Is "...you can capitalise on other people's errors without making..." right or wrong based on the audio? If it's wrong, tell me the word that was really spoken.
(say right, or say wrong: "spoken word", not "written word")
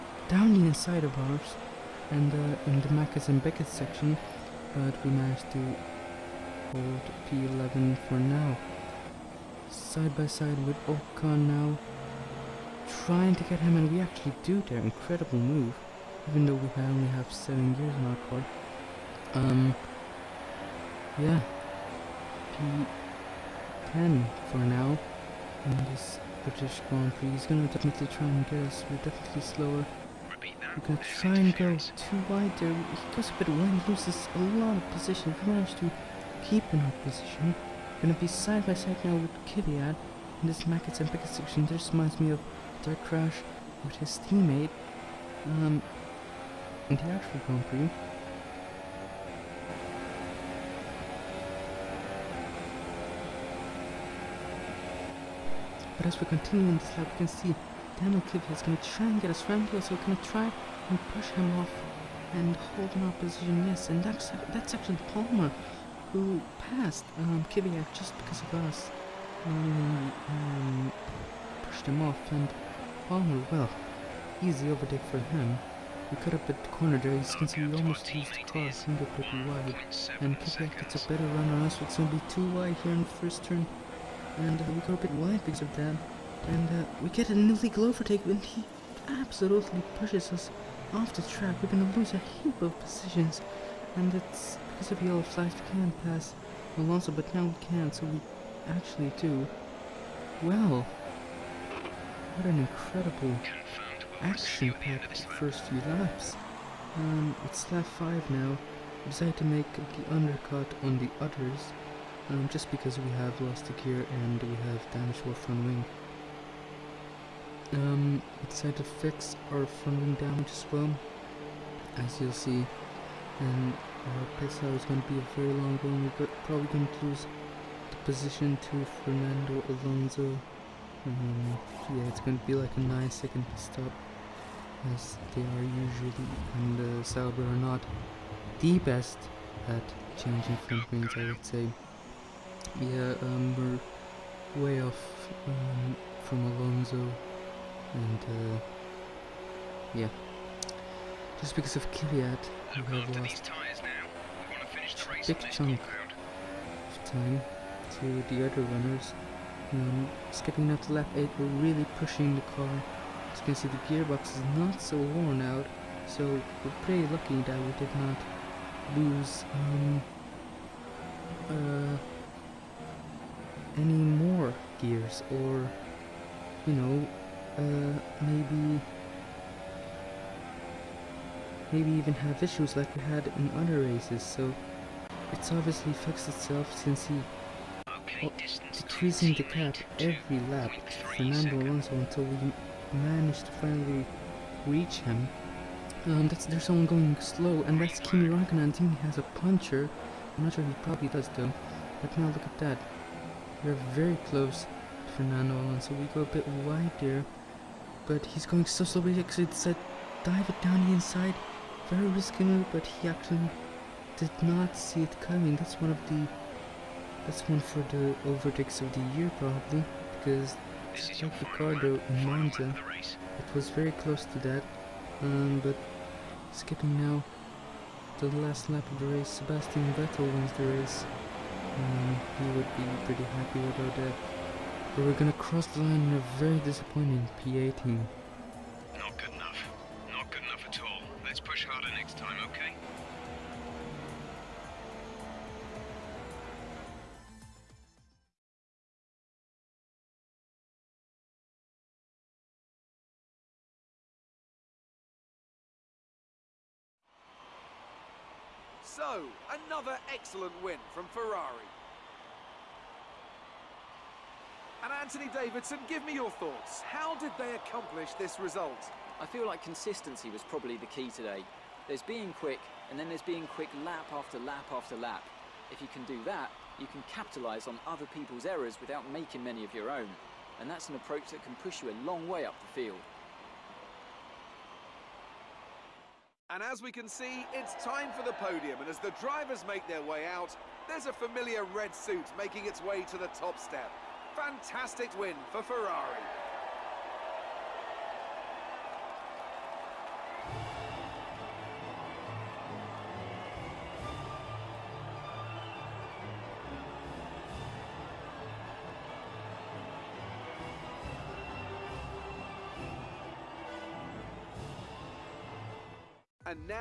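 right.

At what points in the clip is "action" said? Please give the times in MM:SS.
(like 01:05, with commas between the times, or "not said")
01:44.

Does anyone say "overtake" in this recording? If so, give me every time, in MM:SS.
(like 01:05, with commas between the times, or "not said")
01:14, 01:27, 03:38.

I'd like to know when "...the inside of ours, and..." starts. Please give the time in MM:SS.
00:00.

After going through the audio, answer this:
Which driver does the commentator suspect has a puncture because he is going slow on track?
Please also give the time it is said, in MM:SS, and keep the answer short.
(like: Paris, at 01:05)
Kimi Raikkonen, at 03:17.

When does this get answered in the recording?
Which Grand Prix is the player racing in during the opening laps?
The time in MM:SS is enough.
00:26.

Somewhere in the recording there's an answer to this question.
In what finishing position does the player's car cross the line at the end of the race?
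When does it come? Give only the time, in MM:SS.
03:57.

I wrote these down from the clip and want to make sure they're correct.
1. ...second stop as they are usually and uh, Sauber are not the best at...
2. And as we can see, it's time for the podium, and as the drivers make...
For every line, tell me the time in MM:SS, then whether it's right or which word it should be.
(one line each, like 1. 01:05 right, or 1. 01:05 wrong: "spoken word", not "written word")
1. 02:13 right
2. 04:46 right.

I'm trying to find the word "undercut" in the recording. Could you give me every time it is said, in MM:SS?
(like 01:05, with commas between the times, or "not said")
01:50.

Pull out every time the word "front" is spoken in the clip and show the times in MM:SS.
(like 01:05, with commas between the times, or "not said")
01:55, 01:59.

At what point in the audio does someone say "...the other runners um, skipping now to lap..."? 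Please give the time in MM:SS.
02:38.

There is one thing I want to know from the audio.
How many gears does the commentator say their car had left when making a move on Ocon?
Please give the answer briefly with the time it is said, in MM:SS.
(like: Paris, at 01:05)
7, at 00:17.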